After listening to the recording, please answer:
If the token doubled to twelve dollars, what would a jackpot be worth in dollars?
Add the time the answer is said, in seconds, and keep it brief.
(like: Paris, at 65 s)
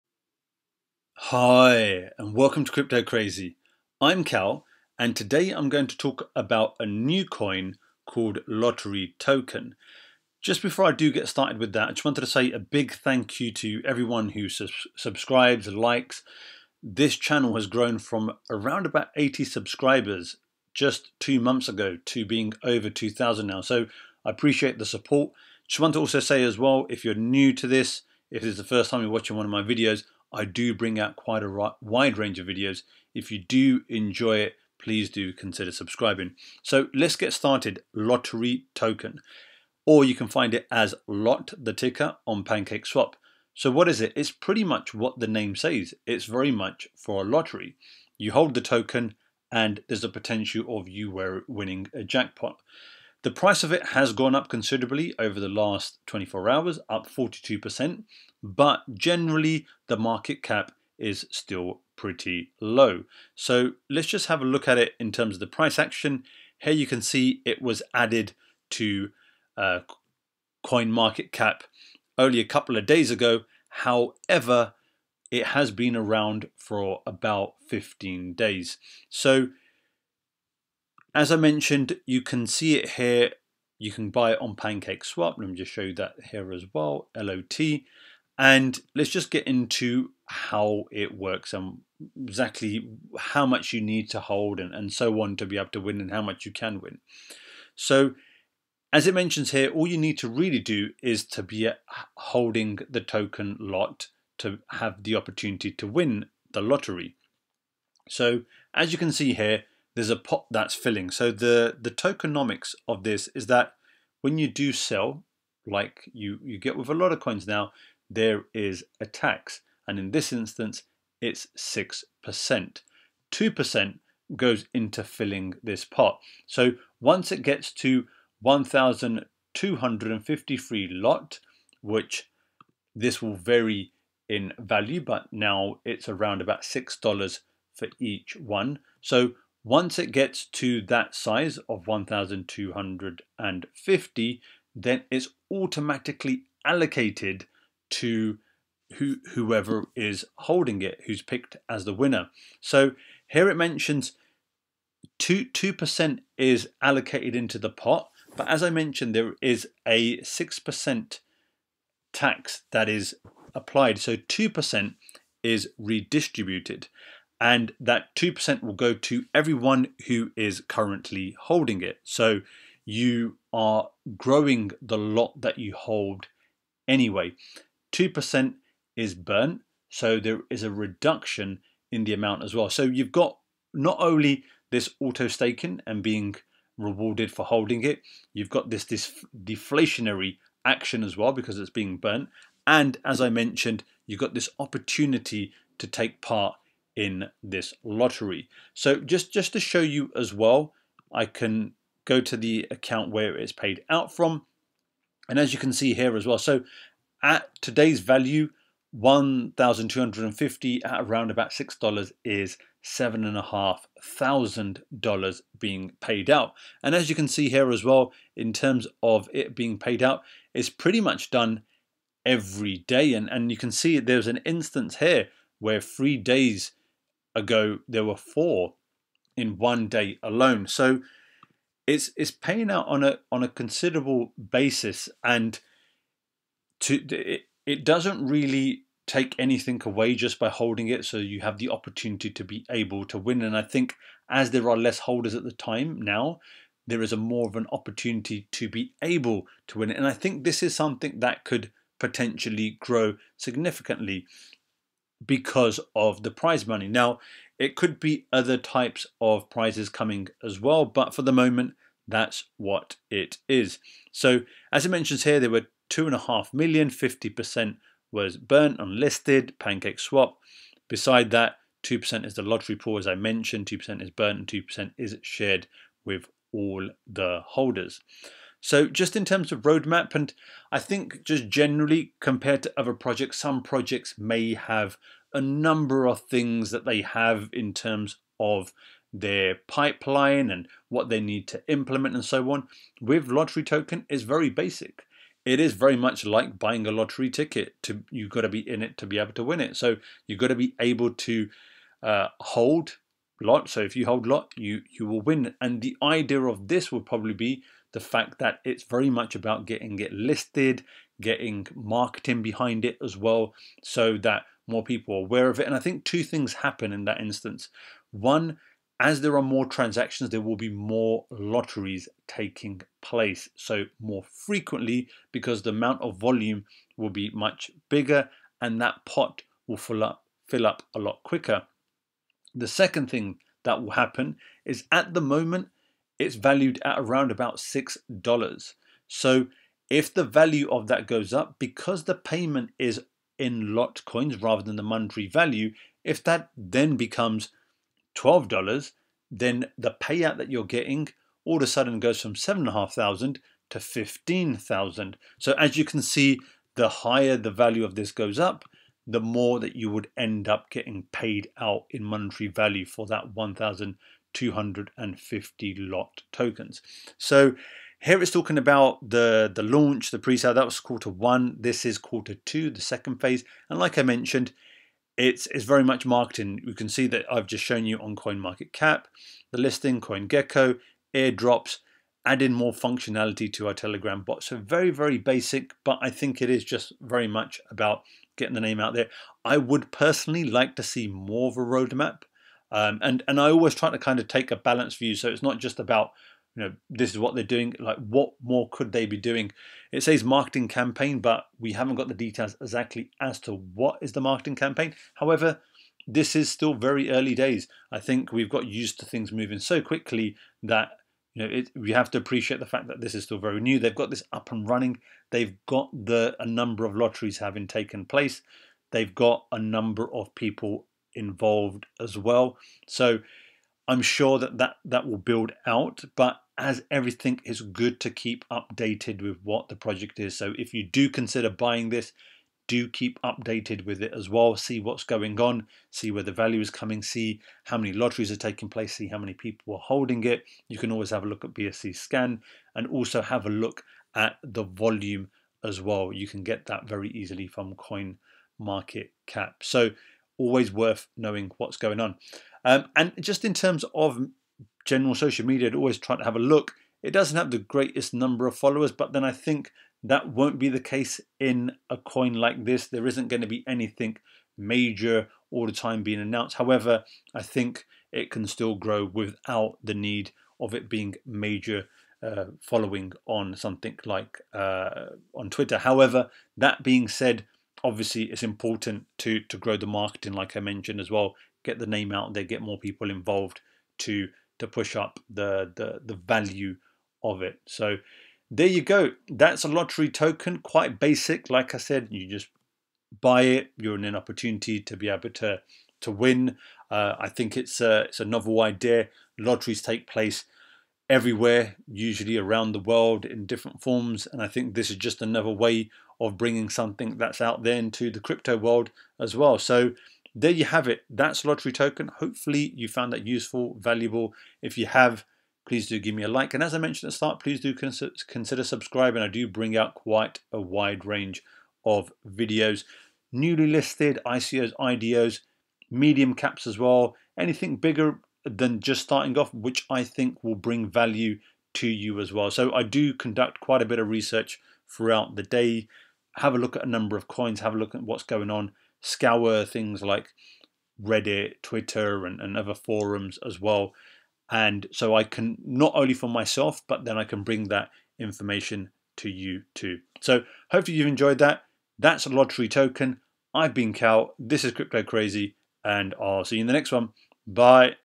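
15,000, at 353 s.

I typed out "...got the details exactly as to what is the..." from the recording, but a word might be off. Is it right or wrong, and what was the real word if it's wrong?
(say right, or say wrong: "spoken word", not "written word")
right.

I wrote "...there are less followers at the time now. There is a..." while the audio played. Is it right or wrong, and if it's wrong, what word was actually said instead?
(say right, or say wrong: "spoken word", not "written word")
wrong: "holders", not "followers".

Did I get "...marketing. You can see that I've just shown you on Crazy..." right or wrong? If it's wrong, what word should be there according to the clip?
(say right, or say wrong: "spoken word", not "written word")
wrong: "CoinMarketCap", not "Crazy".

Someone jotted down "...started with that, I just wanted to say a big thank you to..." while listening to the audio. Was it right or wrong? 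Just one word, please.
right.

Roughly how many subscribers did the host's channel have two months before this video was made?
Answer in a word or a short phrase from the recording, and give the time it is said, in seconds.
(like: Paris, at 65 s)
80, at 19 s.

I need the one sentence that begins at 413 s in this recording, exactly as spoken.
They've got this up and running.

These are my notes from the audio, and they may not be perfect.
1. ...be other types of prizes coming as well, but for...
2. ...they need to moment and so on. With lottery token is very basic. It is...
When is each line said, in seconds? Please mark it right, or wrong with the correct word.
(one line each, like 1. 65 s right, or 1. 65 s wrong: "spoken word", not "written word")
1. 257 s right
2. 291 s wrong: "implement", not "moment".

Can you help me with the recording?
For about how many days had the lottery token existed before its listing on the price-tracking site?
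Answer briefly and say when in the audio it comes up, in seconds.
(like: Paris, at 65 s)
15, at 77 s.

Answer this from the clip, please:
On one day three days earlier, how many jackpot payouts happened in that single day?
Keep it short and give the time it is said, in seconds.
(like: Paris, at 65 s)
4, at 228 s.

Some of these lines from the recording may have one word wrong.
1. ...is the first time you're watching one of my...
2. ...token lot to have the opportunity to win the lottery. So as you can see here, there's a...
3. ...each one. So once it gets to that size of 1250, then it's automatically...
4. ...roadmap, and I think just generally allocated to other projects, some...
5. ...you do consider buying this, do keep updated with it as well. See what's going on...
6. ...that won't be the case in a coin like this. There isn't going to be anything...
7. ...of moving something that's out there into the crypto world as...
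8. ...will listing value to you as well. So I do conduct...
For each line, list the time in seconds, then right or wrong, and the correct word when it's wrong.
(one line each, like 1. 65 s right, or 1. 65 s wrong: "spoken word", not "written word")
1. 28 s right
2. 103 s right
3. 137 s right
4. 279 s wrong: "compared", not "allocated"
5. 430 s right
6. 460 s right
7. 506 s wrong: "bringing", not "moving"
8. 530 s wrong: "bring", not "listing".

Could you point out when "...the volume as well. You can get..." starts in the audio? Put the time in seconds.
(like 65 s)
444 s.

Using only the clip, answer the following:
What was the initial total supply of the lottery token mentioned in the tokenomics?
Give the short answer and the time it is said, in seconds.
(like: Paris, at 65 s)
2.5 million, at 265 s.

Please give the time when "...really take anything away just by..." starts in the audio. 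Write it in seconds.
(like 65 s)
238 s.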